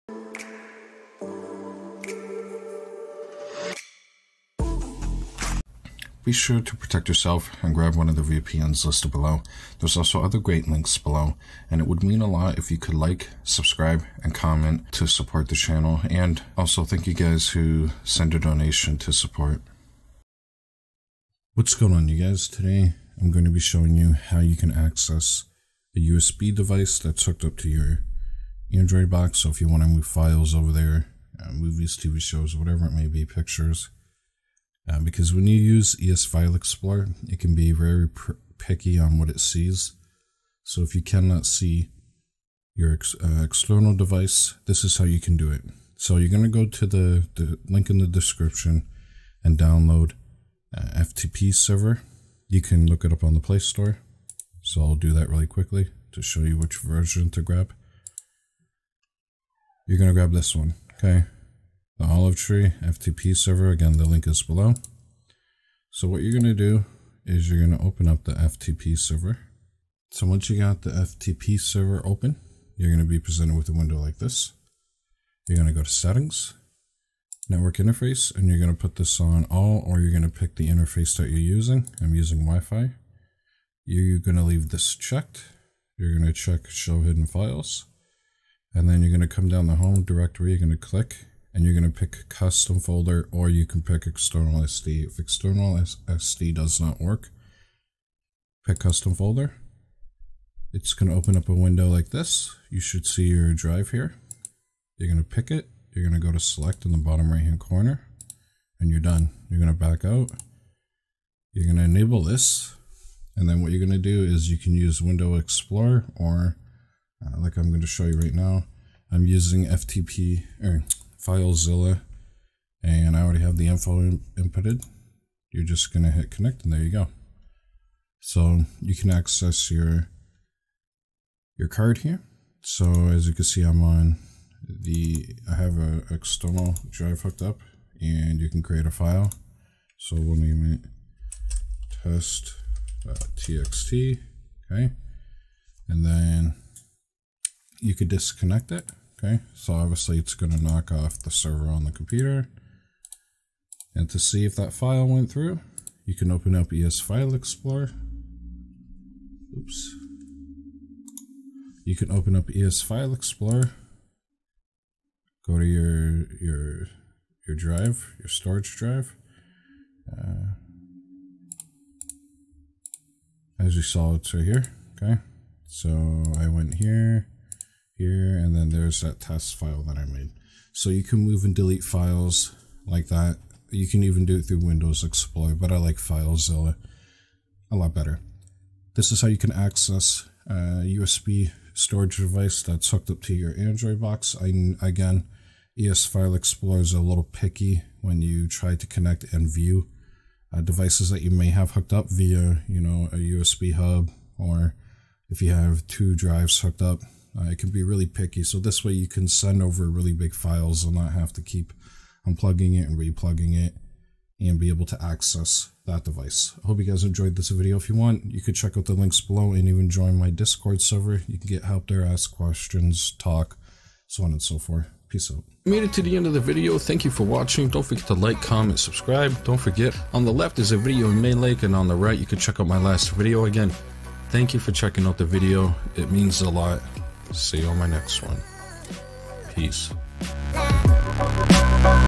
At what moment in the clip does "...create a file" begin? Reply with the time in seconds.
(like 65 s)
138 s.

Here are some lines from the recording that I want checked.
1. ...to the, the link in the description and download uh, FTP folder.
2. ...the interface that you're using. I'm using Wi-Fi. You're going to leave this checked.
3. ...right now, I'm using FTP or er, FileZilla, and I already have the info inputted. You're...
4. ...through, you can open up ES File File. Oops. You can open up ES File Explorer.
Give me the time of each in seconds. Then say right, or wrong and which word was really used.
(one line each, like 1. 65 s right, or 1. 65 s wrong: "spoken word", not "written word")
1. 46 s wrong: "server", not "folder"
2. 80 s right
3. 118 s right
4. 155 s wrong: "Explorer", not "File".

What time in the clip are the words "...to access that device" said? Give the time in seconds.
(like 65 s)
214 s.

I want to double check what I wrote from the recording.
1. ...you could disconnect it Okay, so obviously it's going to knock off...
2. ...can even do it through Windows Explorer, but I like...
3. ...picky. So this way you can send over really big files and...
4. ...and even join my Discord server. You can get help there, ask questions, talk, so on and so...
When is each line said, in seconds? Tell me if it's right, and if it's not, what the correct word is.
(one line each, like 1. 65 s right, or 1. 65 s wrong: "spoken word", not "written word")
1. 147 s right
2. 183 s right
3. 208 s right
4. 219 s right.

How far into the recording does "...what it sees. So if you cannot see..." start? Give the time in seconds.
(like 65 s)
39 s.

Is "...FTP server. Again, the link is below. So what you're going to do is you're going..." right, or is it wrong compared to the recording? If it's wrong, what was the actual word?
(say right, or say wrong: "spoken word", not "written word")
right.